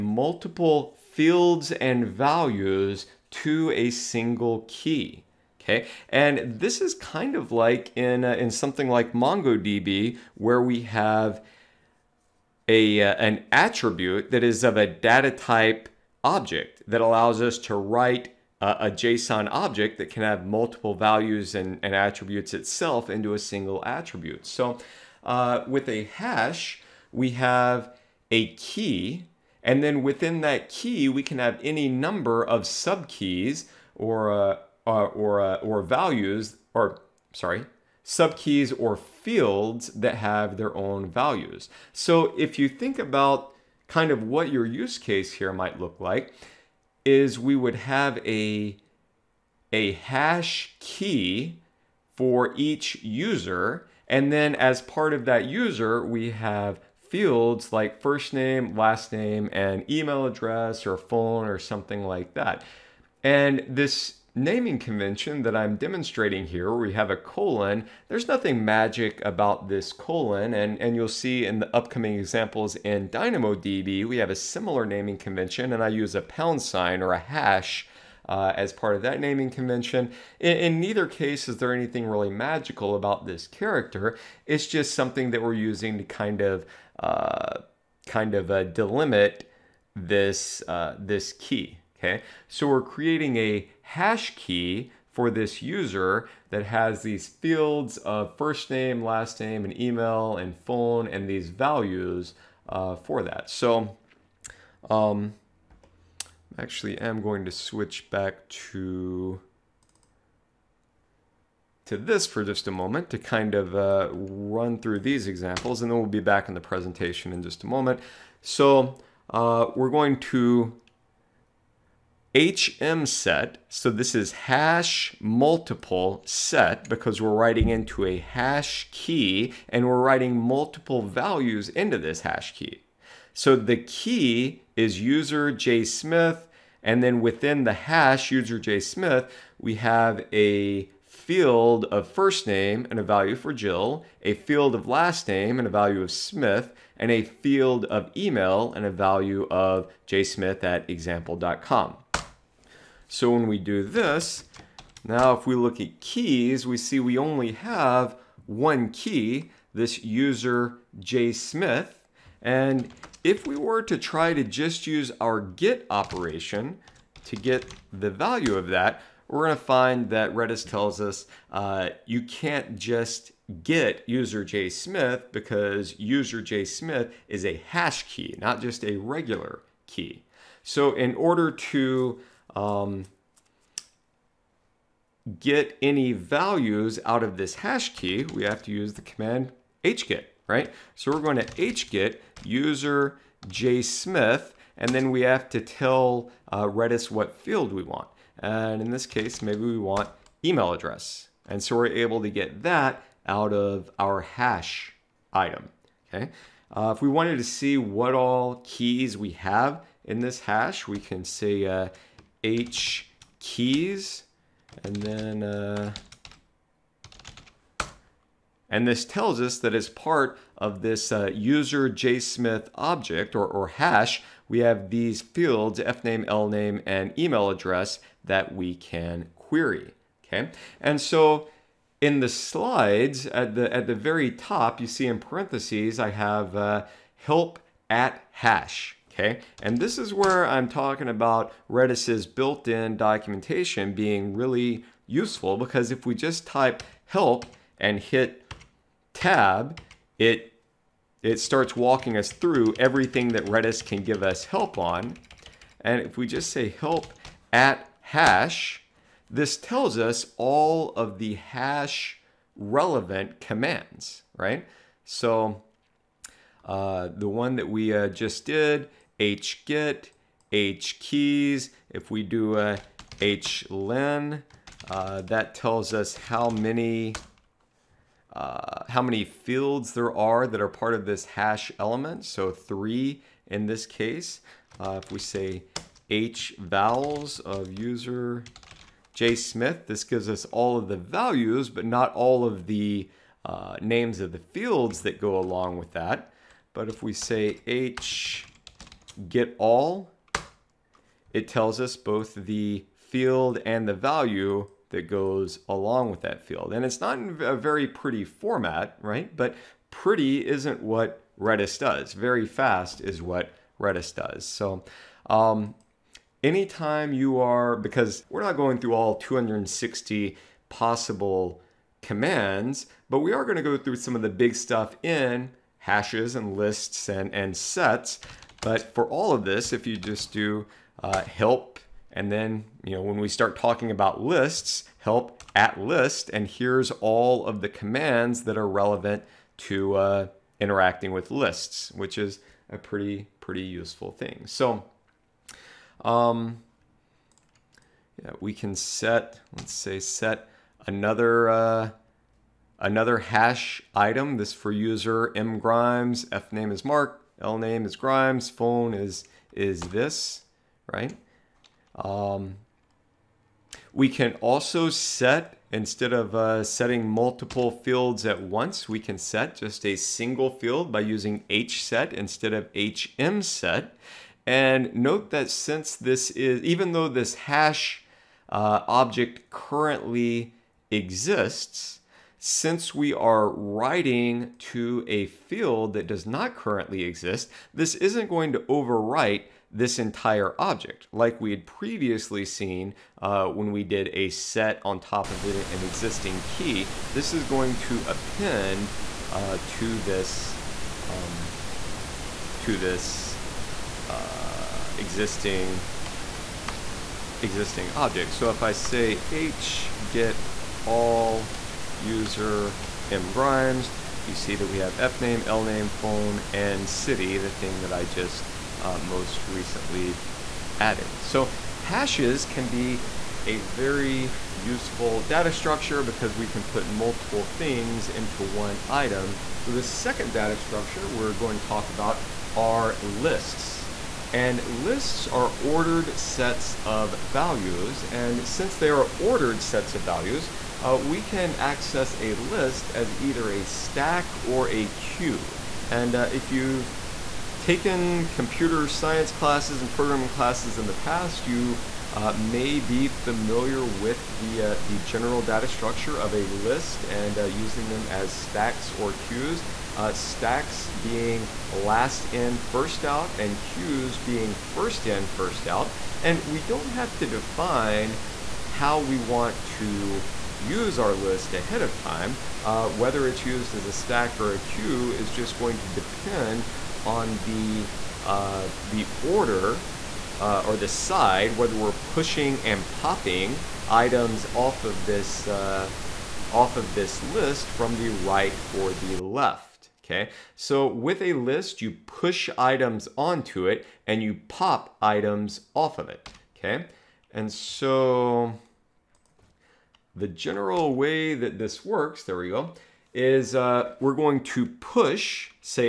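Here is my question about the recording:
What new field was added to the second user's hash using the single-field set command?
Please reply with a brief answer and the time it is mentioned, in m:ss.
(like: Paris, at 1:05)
city, at 6:56.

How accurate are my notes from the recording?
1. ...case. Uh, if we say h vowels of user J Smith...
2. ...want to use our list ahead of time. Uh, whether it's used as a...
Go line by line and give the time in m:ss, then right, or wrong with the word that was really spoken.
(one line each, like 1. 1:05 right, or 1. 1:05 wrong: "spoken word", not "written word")
1. 4:43 right
2. 7:49 right.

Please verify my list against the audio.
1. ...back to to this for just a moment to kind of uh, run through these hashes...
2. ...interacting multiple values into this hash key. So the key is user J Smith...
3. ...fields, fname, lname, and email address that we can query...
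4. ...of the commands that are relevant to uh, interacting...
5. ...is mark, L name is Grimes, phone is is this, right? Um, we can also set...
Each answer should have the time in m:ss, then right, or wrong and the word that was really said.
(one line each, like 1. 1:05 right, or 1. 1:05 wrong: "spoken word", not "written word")
1. 1:48 wrong: "examples", not "hashes"
2. 2:09 wrong: "writing", not "interacting"
3. 3:45 right
4. 5:37 right
5. 5:56 right.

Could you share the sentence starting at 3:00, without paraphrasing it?
So in order to um, get any values out of this hash key, we have to use the command hget, right?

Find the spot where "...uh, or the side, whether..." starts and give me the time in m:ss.
8:00.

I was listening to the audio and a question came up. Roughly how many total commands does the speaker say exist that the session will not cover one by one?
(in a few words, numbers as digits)
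260.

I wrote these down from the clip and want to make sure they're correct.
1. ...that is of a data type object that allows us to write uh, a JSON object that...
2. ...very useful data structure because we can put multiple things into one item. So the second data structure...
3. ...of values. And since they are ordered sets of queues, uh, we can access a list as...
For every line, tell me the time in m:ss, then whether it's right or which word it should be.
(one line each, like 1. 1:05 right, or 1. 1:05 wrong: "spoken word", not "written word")
1. 0:14 right
2. 7:03 right
3. 7:16 wrong: "values", not "queues".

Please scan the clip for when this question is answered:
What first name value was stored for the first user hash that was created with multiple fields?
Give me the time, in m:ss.
2:23.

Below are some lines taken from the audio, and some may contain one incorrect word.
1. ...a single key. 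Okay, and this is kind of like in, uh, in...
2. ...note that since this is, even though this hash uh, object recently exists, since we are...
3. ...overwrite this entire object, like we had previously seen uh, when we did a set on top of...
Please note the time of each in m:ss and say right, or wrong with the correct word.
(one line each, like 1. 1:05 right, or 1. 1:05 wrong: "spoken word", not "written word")
1. 0:03 right
2. 6:14 wrong: "currently", not "recently"
3. 6:28 right.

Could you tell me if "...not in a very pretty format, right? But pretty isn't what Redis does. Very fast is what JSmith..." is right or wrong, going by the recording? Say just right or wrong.
wrong.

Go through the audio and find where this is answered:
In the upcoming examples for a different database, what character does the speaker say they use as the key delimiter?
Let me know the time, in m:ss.
1:16.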